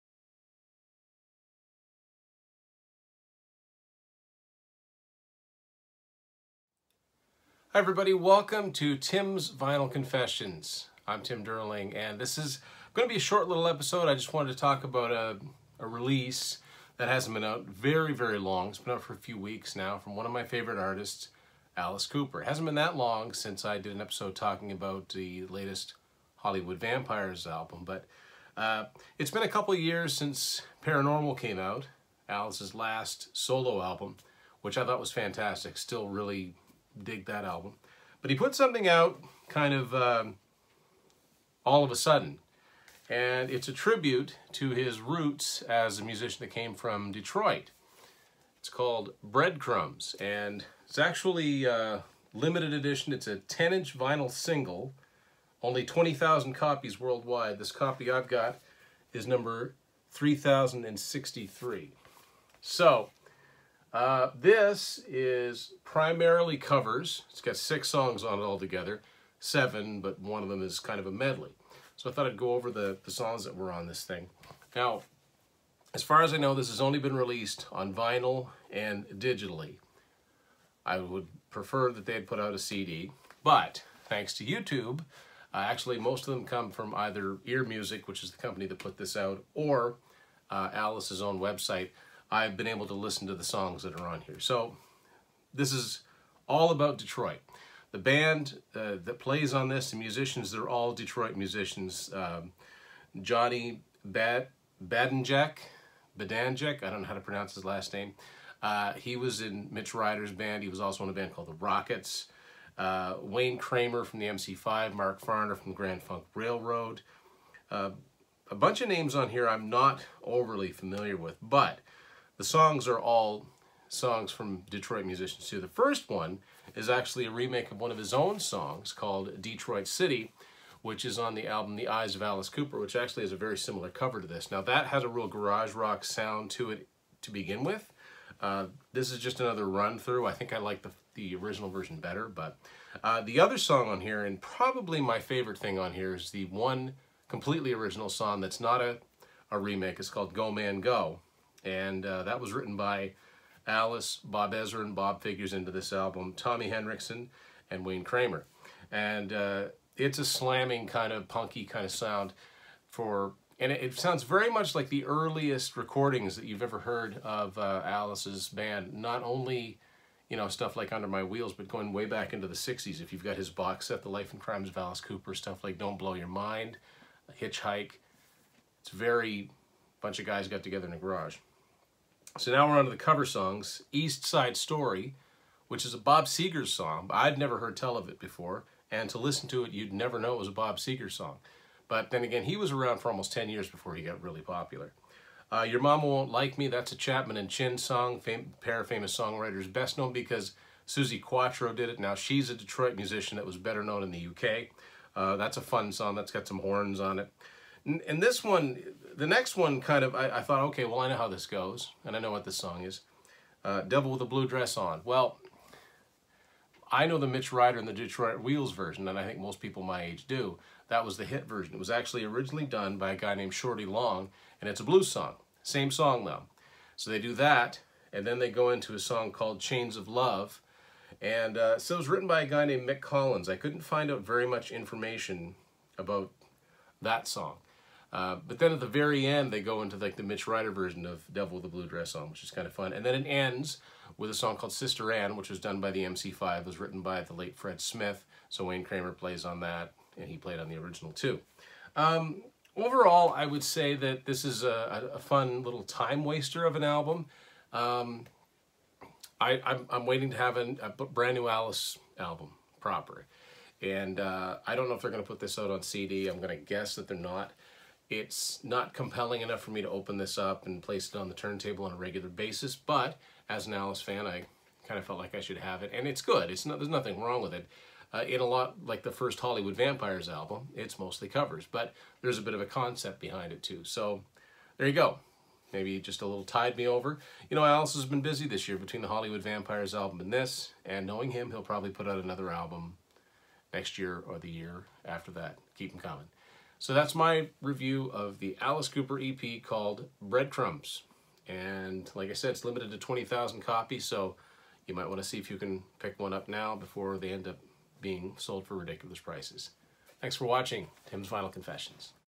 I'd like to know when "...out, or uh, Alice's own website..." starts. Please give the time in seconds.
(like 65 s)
89 s.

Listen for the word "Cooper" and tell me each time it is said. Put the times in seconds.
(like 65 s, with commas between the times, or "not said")
22 s, 132 s, 175 s, 298 s.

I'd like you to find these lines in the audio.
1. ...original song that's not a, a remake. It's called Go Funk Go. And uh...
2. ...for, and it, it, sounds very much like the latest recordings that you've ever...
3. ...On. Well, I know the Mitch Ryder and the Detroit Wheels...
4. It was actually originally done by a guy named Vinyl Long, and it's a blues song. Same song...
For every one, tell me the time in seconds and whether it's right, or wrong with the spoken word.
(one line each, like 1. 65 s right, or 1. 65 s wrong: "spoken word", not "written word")
1. 147 s wrong: "Man", not "Funk"
2. 162 s wrong: "earliest", not "latest"
3. 214 s right
4. 221 s wrong: "Shorty", not "Vinyl".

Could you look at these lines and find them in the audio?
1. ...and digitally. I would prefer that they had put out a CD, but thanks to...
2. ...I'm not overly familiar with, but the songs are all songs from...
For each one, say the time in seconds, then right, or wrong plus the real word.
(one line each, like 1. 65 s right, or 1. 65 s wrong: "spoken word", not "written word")
1. 78 s right
2. 119 s right.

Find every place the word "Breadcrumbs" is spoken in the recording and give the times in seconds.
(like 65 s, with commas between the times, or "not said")
49 s, 300 s.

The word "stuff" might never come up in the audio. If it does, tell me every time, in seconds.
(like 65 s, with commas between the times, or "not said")
170 s, 175 s.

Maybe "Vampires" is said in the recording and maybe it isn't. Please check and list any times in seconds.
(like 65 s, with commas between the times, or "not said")
26 s, 279 s, 289 s.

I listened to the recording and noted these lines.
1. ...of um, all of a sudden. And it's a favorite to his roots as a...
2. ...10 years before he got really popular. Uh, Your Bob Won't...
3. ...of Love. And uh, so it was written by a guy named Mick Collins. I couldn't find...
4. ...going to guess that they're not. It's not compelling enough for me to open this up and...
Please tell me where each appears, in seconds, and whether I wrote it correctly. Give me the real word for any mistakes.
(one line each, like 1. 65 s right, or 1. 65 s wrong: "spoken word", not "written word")
1. 39 s wrong: "tribute", not "favorite"
2. 193 s wrong: "Mama", not "Bob"
3. 229 s right
4. 266 s right.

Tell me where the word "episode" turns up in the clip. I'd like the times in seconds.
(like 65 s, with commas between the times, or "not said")
13 s, 24 s.